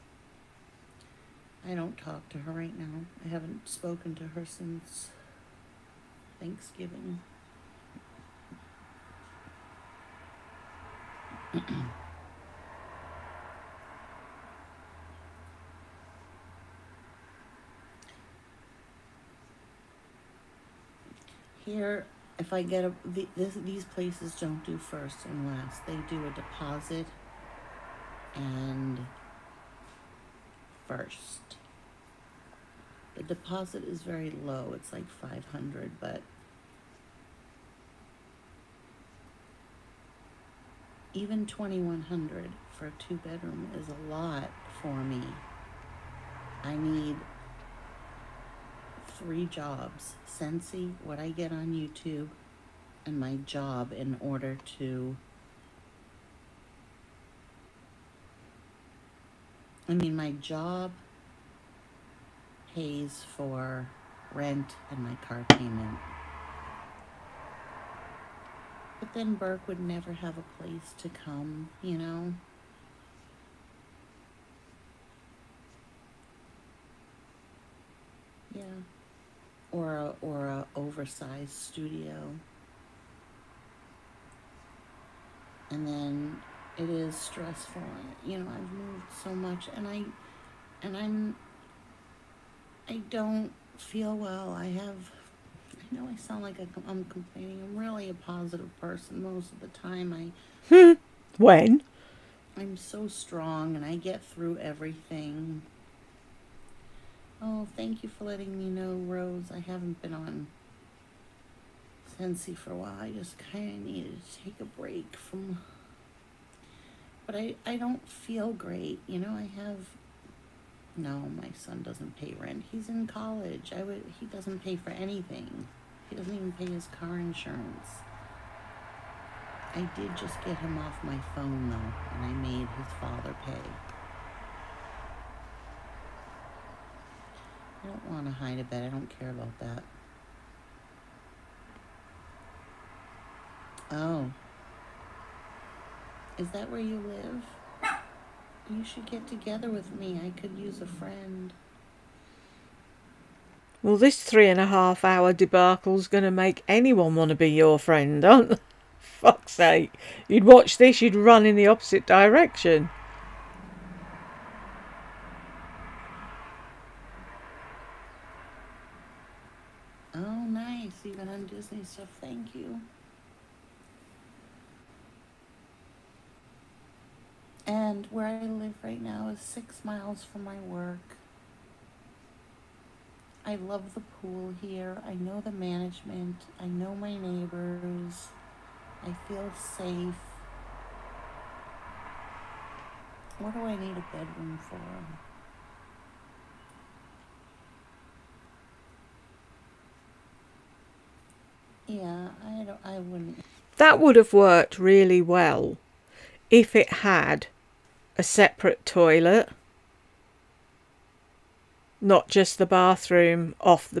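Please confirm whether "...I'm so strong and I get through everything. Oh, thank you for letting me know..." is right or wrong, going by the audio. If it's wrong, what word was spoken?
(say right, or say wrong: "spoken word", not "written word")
right.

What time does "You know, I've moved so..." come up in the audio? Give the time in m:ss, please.
1:28.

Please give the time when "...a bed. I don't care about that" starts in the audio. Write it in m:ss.
2:18.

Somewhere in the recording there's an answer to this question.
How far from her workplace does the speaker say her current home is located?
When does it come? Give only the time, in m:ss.
2:59.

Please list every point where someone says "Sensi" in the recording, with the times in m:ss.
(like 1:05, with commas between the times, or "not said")
0:50, 1:52.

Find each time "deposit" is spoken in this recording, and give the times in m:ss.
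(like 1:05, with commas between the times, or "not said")
0:26, 0:33.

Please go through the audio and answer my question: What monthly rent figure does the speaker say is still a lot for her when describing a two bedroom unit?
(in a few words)
2100.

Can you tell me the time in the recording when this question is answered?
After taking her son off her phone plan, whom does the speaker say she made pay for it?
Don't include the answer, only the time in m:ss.
2:12.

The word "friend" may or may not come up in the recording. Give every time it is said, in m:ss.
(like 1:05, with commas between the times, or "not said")
2:30, 2:37.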